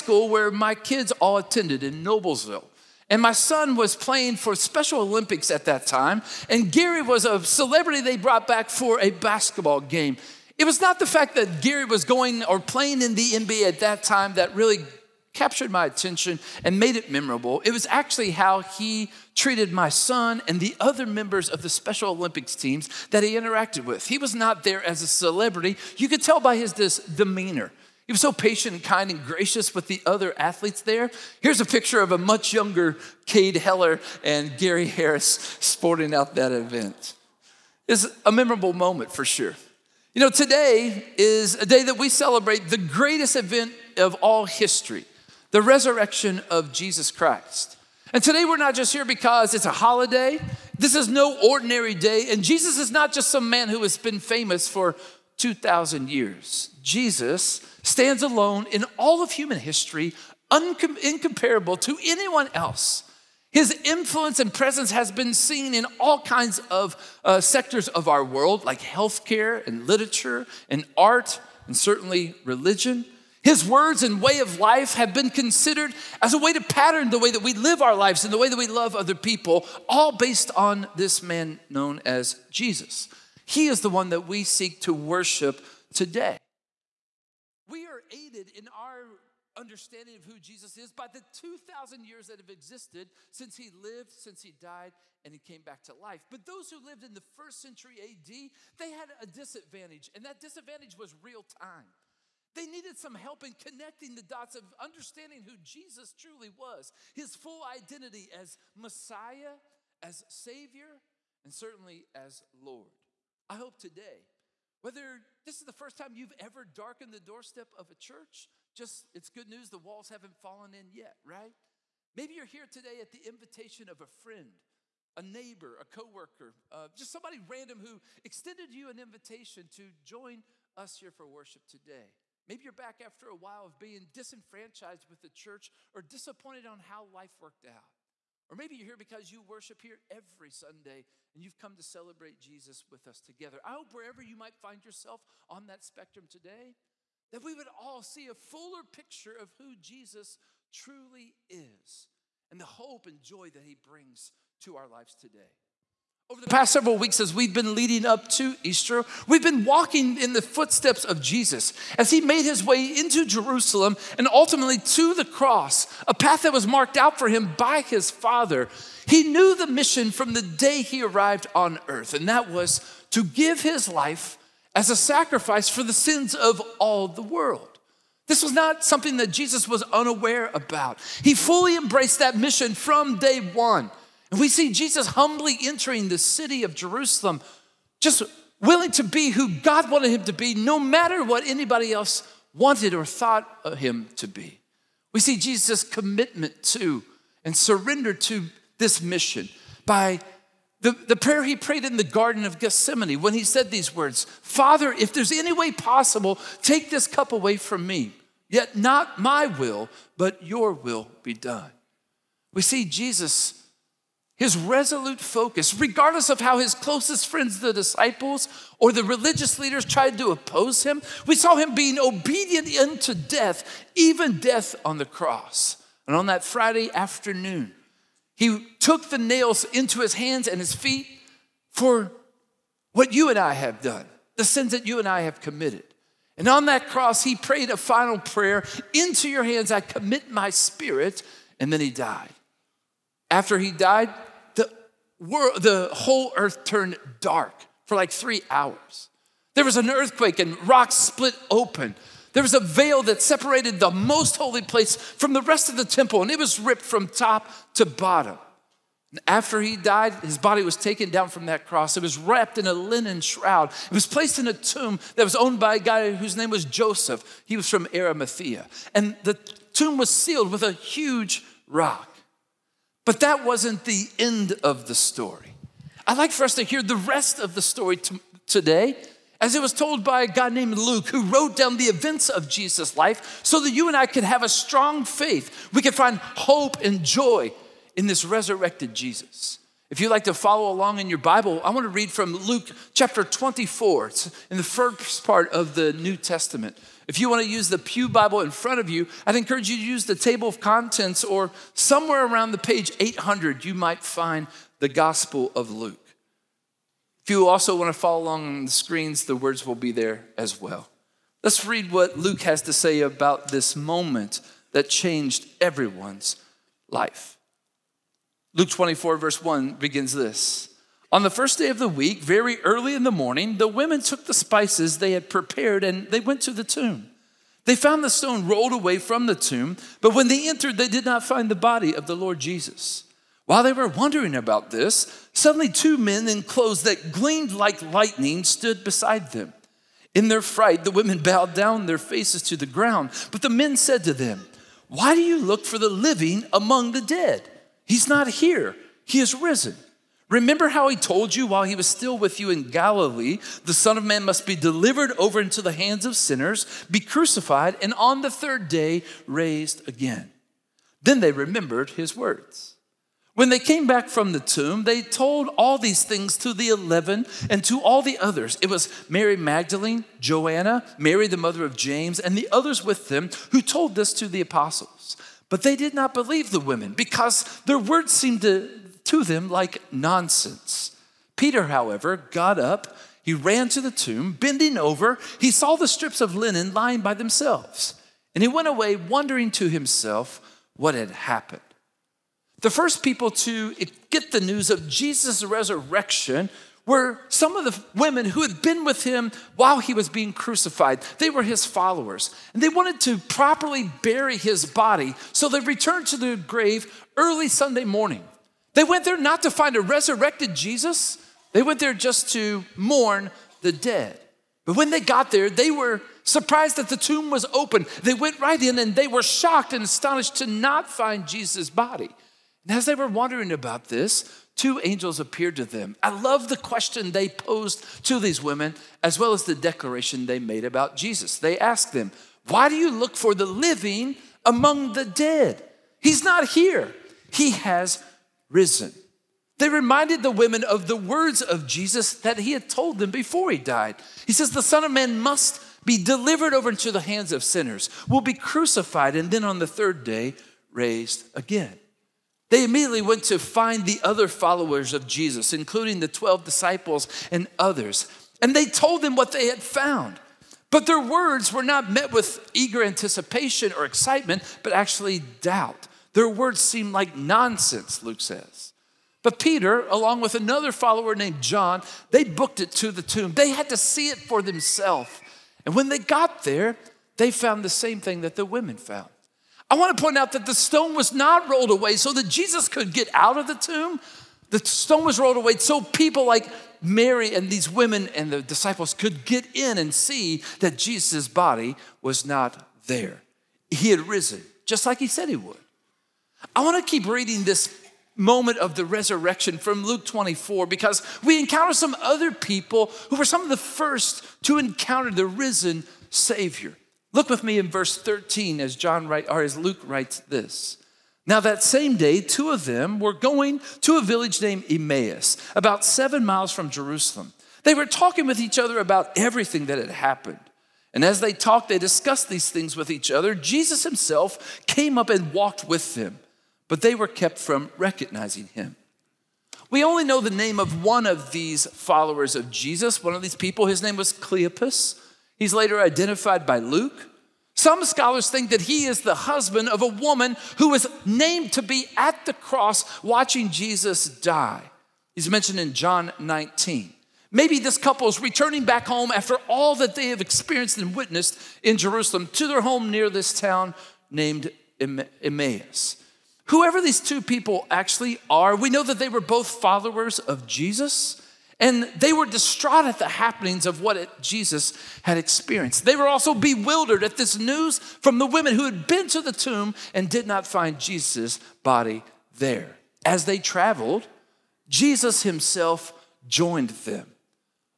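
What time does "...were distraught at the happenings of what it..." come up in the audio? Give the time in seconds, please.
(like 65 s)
562 s.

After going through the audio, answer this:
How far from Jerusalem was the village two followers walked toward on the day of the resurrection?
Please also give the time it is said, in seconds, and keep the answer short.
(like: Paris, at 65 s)
7 miles, at 515 s.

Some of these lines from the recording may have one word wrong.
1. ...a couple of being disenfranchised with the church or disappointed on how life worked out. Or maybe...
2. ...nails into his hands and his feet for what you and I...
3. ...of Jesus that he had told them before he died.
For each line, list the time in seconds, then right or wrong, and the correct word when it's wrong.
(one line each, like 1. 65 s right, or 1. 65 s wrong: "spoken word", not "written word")
1. 133 s wrong: "while", not "couple"
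2. 229 s right
3. 441 s right.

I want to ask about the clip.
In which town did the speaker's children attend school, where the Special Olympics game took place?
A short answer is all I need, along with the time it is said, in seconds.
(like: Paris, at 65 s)
Noblesville, at 2 s.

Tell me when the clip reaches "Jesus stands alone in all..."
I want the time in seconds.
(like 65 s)
56 s.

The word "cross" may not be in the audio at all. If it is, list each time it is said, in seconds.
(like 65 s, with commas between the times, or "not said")
165 s, 225 s, 236 s, 261 s, 542 s.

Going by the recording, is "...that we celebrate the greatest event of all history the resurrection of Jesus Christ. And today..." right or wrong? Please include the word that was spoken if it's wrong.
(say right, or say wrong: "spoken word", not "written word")
right.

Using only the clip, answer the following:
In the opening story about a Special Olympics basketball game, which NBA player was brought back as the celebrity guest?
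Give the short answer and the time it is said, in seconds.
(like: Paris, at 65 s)
Gary Harris, at 34 s.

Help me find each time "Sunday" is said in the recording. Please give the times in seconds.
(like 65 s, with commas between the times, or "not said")
140 s, 407 s.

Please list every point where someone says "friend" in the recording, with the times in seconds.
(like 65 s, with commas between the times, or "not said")
124 s, 217 s.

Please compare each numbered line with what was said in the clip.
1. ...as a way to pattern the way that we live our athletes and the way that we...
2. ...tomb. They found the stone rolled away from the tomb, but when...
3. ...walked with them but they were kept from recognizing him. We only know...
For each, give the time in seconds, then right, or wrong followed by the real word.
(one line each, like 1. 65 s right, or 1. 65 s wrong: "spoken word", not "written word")
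1. 76 s wrong: "lives", not "athletes"
2. 326 s right
3. 525 s right.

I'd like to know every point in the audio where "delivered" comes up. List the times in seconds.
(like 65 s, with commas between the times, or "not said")
354 s, 446 s.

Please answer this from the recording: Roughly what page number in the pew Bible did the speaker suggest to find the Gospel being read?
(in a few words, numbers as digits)
800.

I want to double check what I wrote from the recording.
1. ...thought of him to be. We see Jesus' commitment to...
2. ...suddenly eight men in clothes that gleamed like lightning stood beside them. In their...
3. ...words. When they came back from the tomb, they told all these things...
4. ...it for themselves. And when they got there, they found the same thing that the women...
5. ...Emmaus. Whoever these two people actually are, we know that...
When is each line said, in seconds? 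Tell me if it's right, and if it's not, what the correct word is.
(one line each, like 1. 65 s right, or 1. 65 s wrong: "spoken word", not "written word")
1. 193 s right
2. 335 s wrong: "two", not "eight"
3. 362 s right
4. 474 s right
5. 554 s right.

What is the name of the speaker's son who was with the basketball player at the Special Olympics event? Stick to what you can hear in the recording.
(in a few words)
Cade Heller.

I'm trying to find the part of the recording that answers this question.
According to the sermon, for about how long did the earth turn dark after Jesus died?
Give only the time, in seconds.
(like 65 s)
248 s.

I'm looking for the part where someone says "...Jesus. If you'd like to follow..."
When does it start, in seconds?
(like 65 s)
288 s.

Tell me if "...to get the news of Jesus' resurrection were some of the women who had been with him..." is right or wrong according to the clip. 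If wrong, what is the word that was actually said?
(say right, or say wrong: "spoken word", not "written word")
right.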